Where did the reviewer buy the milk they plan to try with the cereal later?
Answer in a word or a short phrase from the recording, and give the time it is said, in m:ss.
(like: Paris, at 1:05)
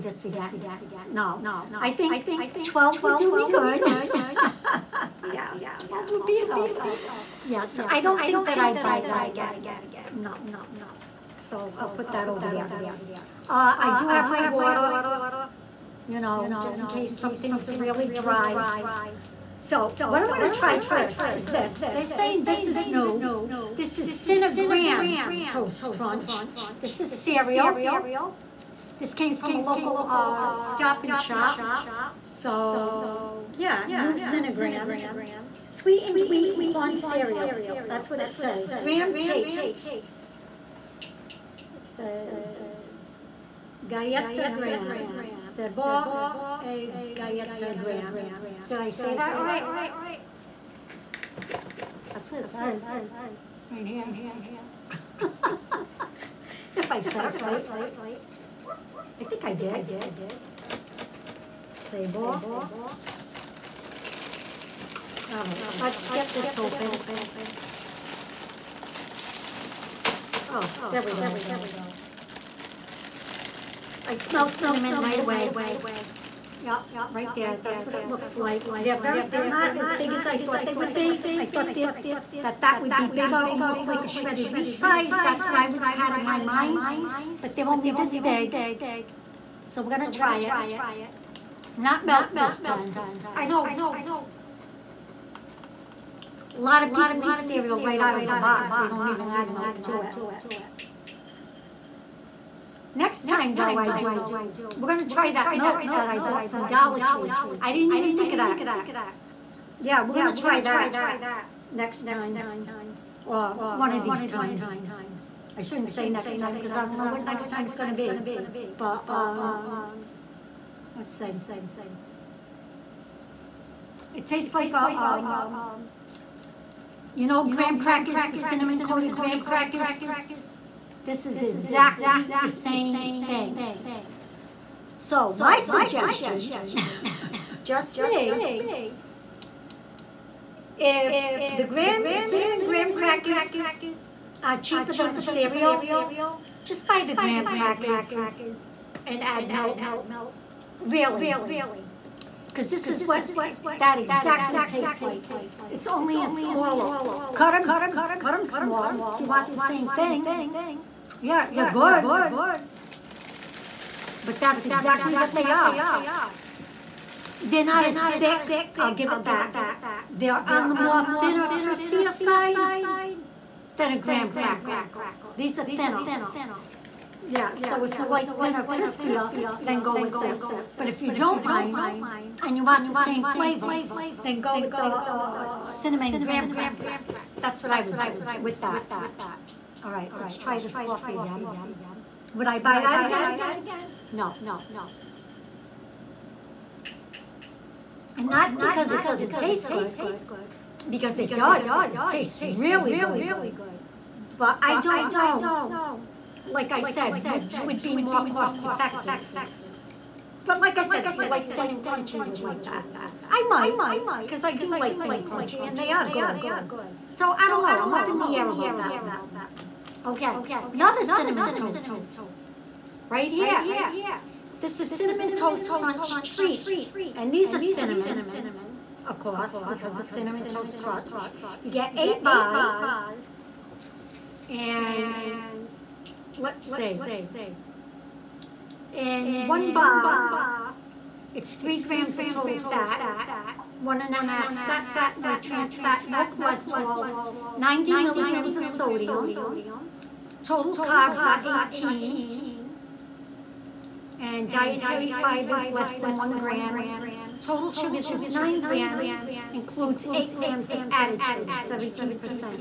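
Dollar Tree, at 1:46.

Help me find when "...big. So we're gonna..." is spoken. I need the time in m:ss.
1:28.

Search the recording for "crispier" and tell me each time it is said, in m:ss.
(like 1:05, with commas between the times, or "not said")
2:51, 2:58.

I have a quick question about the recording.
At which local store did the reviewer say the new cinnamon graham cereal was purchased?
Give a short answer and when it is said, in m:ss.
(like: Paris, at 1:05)
Stop and Shop, at 0:30.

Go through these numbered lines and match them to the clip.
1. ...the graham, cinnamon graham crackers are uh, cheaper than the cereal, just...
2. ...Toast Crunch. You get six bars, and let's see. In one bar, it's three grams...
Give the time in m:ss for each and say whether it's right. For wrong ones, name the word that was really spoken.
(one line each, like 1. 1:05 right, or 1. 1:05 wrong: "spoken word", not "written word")
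1. 2:21 right
2. 3:50 wrong: "eight", not "six".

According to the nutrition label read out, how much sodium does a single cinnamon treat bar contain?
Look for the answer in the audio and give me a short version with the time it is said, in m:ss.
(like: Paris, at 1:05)
90 milligrams, at 4:07.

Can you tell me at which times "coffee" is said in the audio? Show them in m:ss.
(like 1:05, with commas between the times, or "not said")
3:10.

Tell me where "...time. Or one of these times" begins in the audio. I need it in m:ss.
1:52.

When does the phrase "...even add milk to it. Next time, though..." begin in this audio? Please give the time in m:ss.
1:39.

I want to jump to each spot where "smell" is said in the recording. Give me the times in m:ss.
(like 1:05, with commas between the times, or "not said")
1:14.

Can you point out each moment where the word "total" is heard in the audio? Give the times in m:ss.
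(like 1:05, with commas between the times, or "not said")
4:02, 4:10, 4:17.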